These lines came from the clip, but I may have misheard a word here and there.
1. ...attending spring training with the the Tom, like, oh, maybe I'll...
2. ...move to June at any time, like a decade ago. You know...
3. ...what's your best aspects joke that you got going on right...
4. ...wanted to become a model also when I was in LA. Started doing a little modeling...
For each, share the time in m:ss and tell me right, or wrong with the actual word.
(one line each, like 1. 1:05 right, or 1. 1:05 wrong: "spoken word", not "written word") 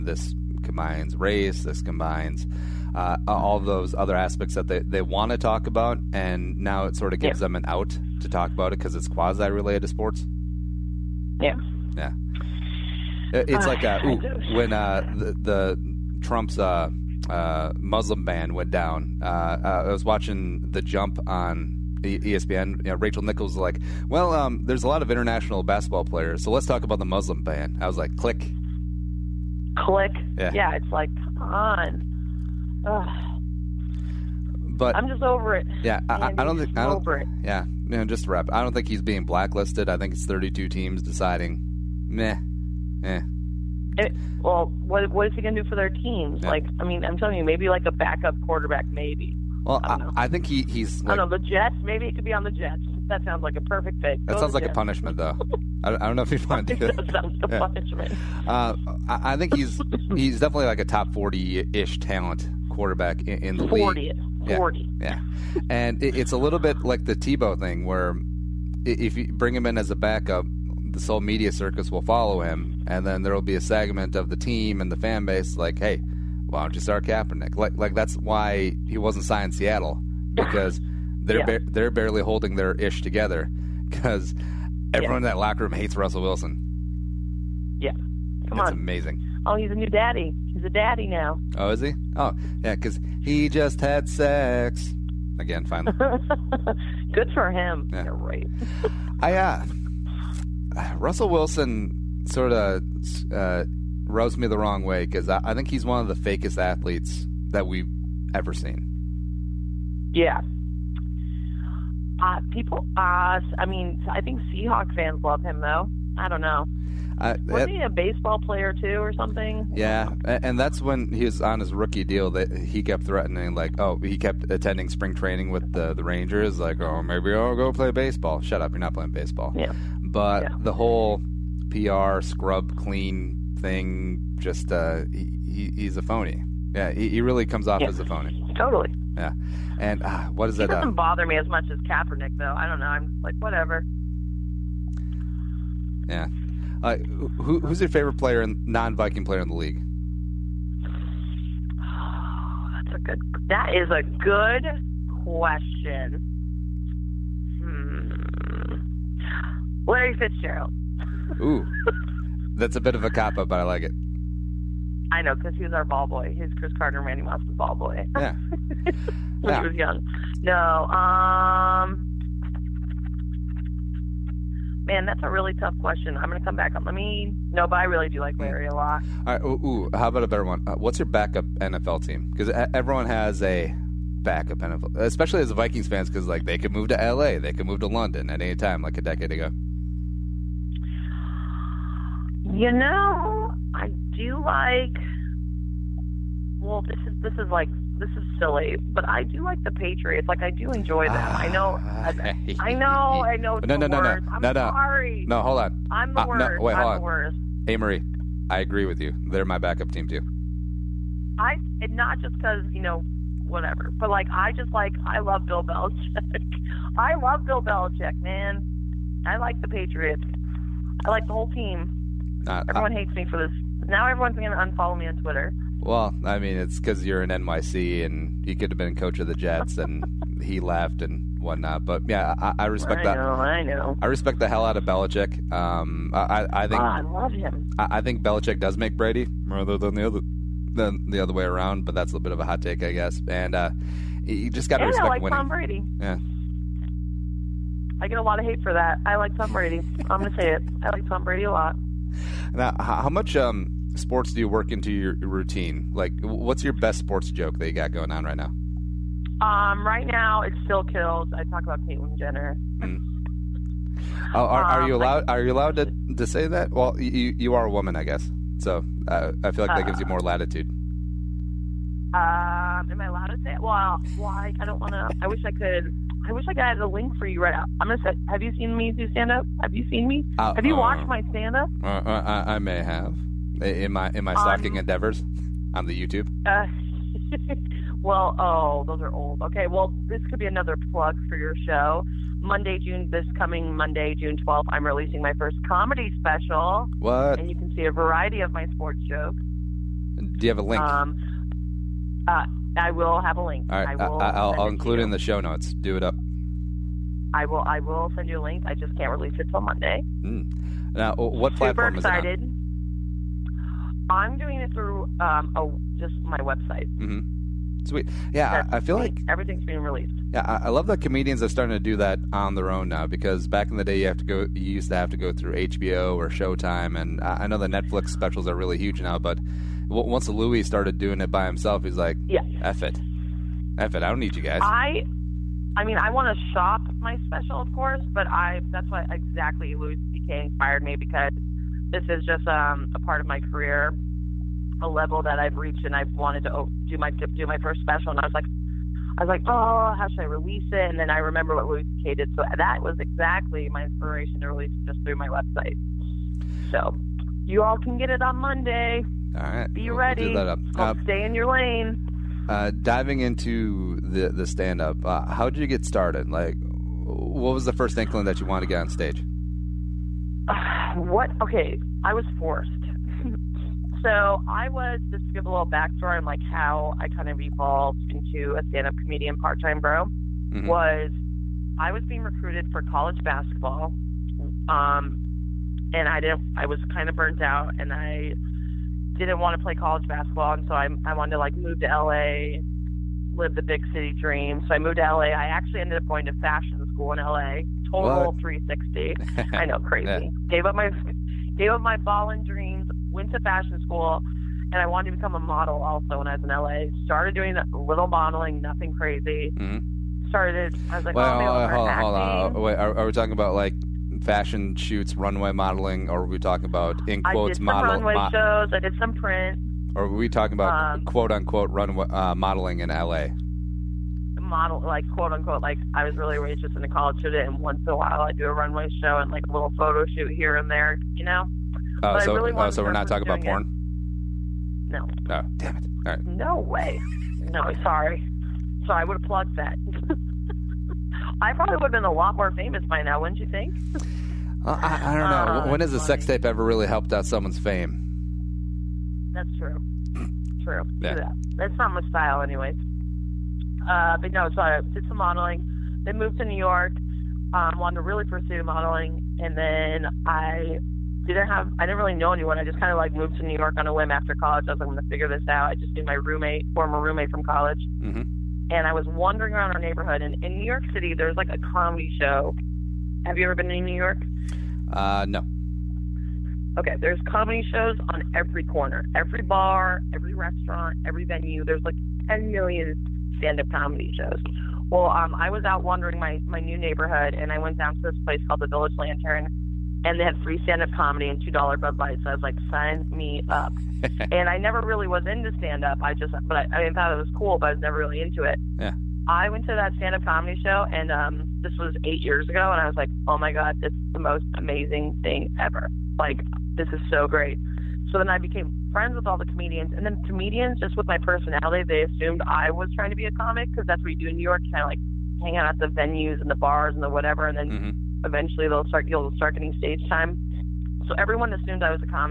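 1. 2:04 wrong: "Rangers", not "Tom"
2. 3:07 wrong: "London", not "June"
3. 4:16 wrong: "sports", not "aspects"
4. 6:44 right.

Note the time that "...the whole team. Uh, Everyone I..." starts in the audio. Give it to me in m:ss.
3:41.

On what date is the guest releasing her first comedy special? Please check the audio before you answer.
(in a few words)
June 12th.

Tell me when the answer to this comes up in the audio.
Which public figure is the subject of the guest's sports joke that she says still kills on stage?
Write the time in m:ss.
4:21.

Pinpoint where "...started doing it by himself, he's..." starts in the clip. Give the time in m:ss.
5:30.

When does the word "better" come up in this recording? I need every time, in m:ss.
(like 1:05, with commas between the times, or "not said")
3:00.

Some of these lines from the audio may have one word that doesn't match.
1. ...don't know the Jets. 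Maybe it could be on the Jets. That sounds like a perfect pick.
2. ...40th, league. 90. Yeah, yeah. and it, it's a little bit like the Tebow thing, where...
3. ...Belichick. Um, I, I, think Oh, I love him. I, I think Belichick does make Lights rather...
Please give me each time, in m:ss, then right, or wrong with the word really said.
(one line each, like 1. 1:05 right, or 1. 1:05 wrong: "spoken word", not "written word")
1. 0:51 right
2. 1:03 wrong: "40", not "90"
3. 3:54 wrong: "Brady", not "Lights".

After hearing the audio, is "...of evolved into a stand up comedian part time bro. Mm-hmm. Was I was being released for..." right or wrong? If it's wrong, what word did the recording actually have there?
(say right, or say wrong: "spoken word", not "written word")
wrong: "recruited", not "released".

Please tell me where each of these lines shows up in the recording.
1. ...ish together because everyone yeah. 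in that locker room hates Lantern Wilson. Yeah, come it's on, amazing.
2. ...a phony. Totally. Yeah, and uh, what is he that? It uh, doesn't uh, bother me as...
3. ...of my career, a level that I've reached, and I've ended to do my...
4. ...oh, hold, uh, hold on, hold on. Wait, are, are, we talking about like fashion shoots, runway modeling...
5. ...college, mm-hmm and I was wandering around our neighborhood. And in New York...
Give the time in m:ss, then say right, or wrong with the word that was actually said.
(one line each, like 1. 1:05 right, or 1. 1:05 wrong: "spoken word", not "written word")
1. 1:22 wrong: "Russell", not "Lantern"
2. 2:18 right
3. 5:43 wrong: "wanted", not "ended"
4. 6:51 right
5. 7:47 right.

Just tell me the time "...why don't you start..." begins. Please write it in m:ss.
1:16.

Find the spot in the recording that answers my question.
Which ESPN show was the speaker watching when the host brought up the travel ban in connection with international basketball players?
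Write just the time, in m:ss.
0:20.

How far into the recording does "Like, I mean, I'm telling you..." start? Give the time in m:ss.
0:46.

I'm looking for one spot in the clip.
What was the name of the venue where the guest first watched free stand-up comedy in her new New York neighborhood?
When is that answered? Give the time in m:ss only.
8:08.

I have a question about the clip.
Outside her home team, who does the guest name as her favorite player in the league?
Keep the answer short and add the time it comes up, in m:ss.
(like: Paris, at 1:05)
Larry Fitzgerald, at 2:39.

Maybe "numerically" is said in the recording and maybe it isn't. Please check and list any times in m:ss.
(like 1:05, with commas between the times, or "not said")
not said.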